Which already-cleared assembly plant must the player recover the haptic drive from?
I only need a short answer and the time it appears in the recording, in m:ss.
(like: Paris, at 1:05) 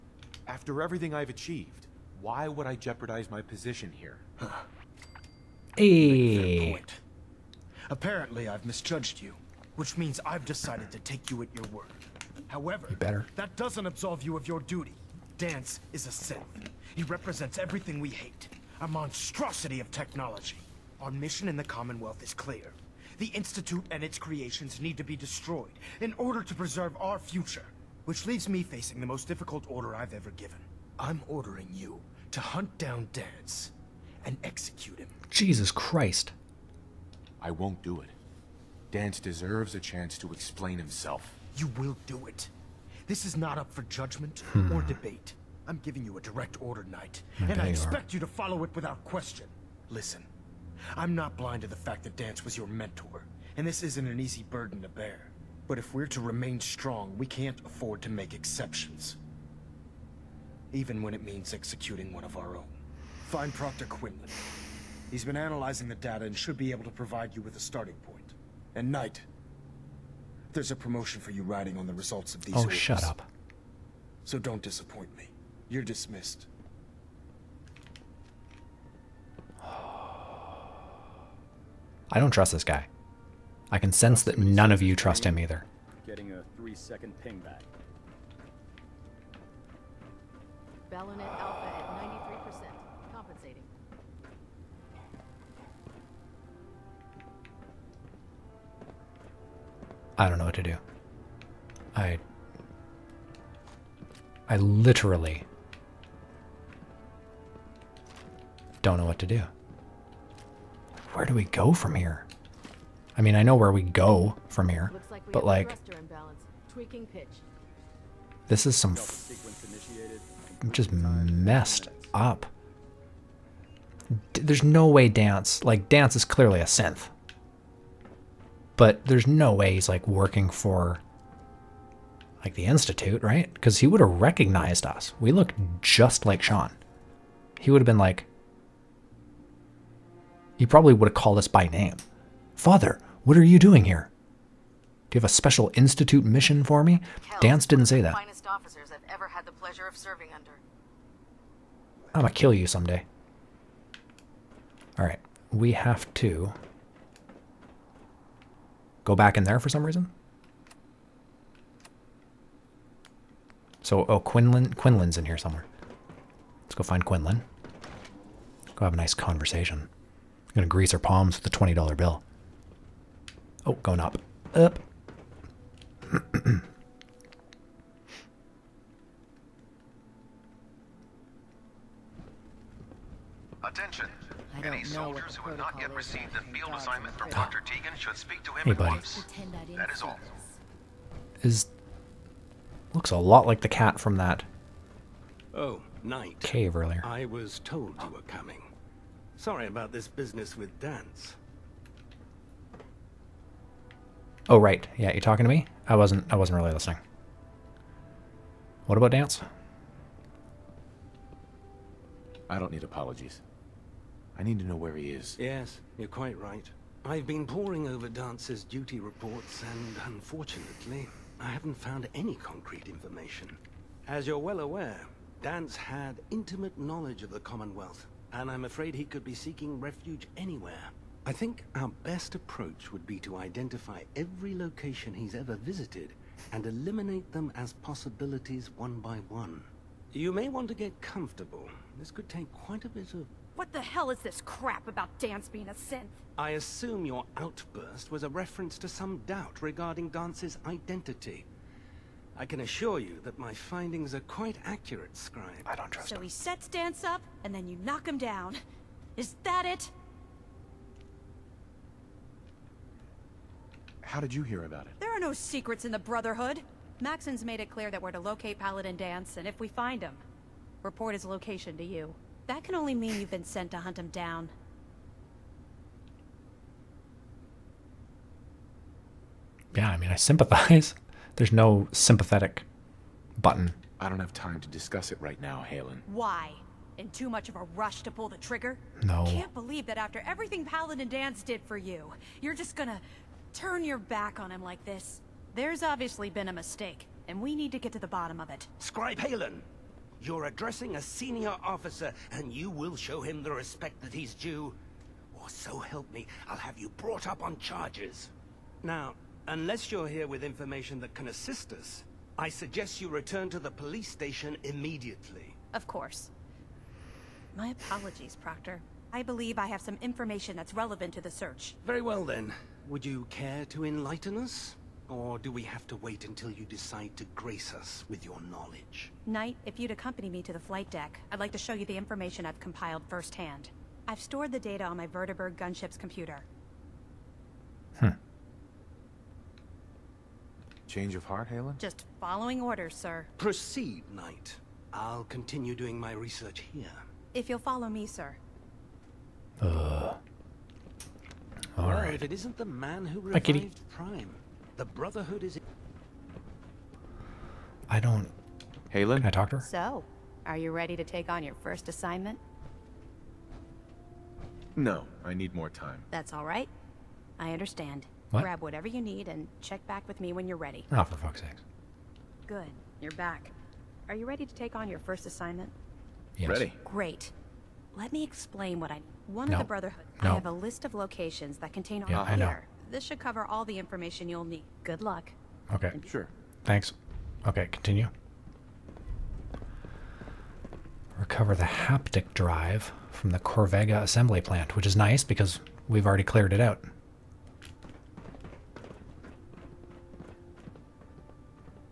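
Corvega, at 6:33.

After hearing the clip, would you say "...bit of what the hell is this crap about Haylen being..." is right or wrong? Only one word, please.
wrong.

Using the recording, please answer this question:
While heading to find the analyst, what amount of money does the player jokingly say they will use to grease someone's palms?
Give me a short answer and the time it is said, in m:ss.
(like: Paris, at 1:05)
$20, at 2:51.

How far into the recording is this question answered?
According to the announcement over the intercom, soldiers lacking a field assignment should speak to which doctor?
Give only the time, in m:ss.
3:07.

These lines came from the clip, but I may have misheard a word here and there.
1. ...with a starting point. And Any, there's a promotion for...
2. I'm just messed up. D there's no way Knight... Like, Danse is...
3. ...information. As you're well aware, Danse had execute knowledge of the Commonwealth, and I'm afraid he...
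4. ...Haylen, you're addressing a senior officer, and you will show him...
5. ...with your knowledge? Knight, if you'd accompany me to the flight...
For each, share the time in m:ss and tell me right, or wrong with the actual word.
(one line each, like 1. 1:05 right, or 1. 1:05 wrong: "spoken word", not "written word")
1. 1:07 wrong: "Knight", not "Any"
2. 2:00 wrong: "Danse", not "Knight"
3. 3:42 wrong: "intimate", not "execute"
4. 4:59 right
5. 5:28 right.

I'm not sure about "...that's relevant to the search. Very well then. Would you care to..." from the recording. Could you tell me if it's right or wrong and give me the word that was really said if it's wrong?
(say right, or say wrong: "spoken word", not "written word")
right.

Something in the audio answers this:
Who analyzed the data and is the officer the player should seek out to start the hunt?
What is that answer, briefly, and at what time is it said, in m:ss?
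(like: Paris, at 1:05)
Proctor Quinlan, at 1:03.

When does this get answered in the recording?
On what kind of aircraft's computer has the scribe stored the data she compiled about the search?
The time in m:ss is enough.
5:35.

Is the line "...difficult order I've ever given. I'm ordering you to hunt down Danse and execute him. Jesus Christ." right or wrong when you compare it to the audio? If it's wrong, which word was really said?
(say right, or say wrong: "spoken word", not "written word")
right.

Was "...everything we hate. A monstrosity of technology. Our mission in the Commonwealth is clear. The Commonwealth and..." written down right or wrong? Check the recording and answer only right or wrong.
wrong.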